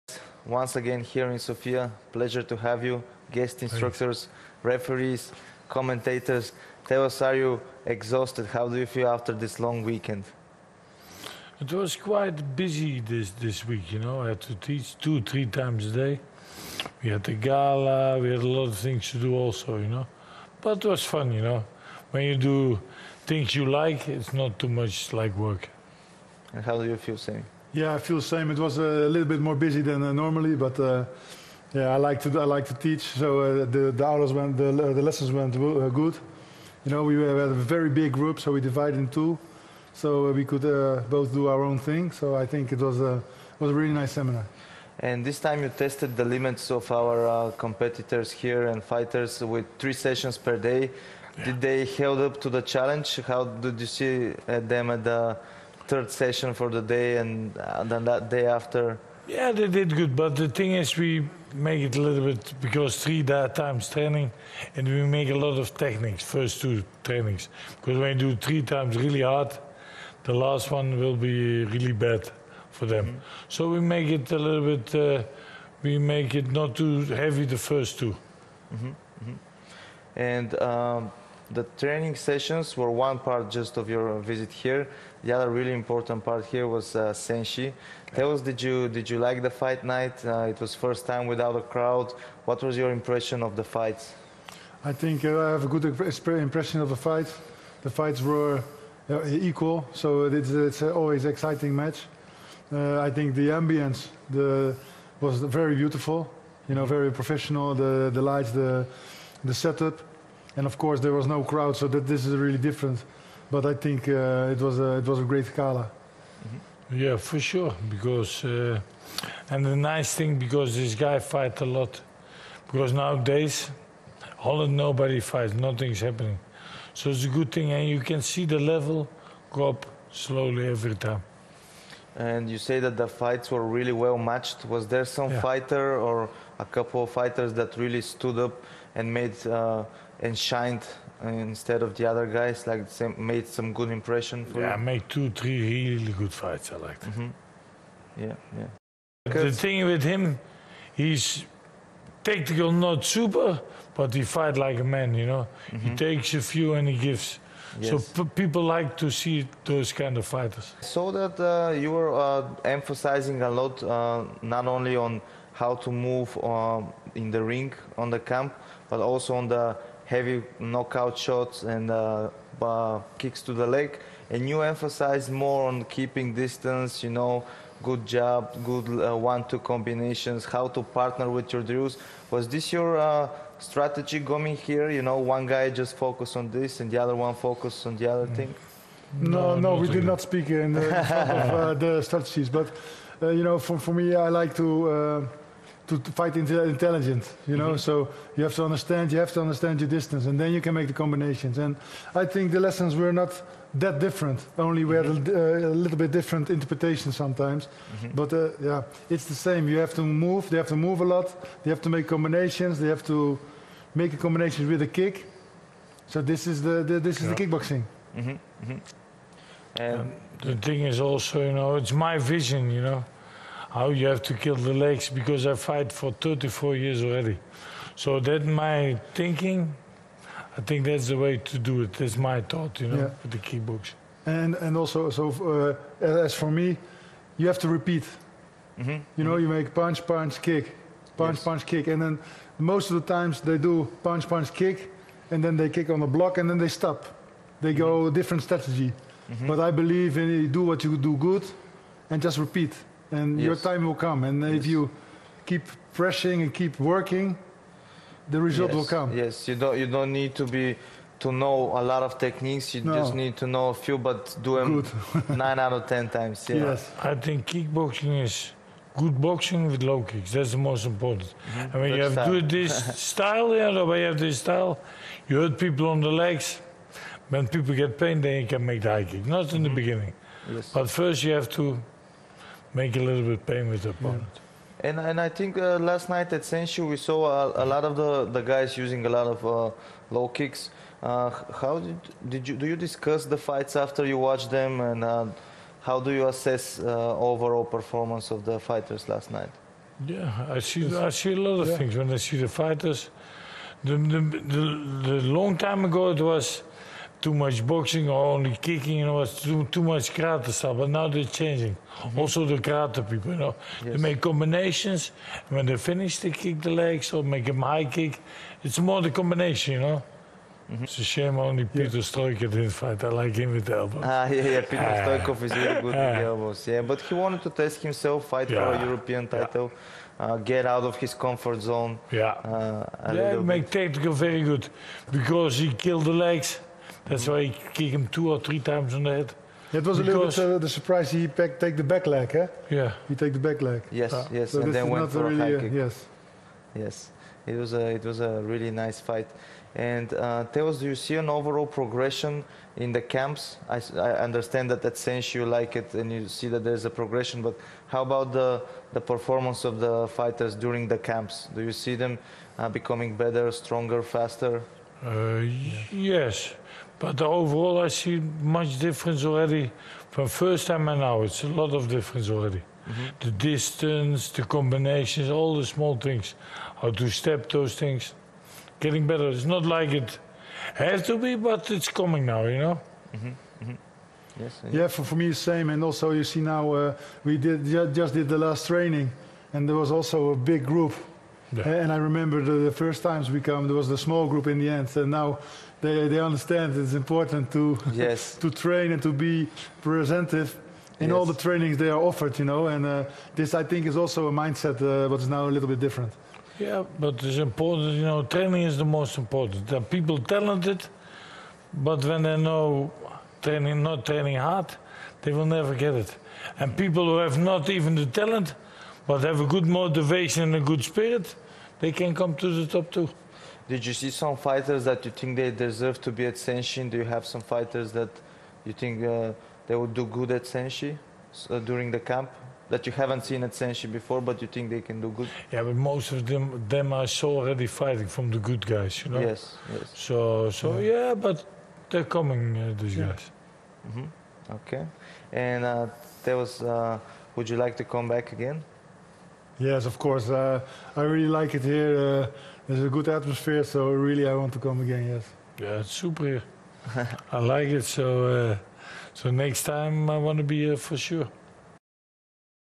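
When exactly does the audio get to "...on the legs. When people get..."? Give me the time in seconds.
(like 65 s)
275 s.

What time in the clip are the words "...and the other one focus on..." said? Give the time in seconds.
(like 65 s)
186 s.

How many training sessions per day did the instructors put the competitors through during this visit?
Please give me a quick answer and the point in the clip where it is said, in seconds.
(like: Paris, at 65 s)
3, at 49 s.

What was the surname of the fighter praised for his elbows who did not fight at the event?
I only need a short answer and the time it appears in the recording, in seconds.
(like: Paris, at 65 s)
Stoikov, at 325 s.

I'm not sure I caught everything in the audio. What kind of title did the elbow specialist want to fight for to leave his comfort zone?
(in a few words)
European title.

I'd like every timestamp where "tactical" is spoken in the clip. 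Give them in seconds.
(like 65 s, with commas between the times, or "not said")
152 s.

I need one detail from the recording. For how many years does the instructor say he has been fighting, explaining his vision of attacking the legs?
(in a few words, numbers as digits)
34.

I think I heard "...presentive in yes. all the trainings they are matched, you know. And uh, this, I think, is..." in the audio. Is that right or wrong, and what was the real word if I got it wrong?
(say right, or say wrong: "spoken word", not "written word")
wrong: "offered", not "matched".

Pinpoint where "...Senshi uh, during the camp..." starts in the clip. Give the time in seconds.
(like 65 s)
430 s.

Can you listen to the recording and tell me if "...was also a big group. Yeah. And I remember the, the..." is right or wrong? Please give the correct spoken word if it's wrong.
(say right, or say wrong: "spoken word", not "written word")
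right.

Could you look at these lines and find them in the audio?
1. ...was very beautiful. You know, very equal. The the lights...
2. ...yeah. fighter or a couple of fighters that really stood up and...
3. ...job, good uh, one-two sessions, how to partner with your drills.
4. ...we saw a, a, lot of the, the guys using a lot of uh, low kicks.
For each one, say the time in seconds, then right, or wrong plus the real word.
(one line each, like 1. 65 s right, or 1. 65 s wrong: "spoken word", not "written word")
1. 105 s wrong: "professional", not "equal"
2. 135 s right
3. 178 s wrong: "combinations", not "sessions"
4. 286 s right.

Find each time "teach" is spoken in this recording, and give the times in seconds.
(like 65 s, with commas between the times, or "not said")
14 s, 32 s.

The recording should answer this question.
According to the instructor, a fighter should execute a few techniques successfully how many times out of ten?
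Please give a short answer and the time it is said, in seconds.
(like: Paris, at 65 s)
9, at 265 s.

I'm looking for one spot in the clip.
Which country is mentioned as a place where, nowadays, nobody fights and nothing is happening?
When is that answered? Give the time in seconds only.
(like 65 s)
124 s.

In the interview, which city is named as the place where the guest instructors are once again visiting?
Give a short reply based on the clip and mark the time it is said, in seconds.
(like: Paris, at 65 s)
Sofia, at 1 s.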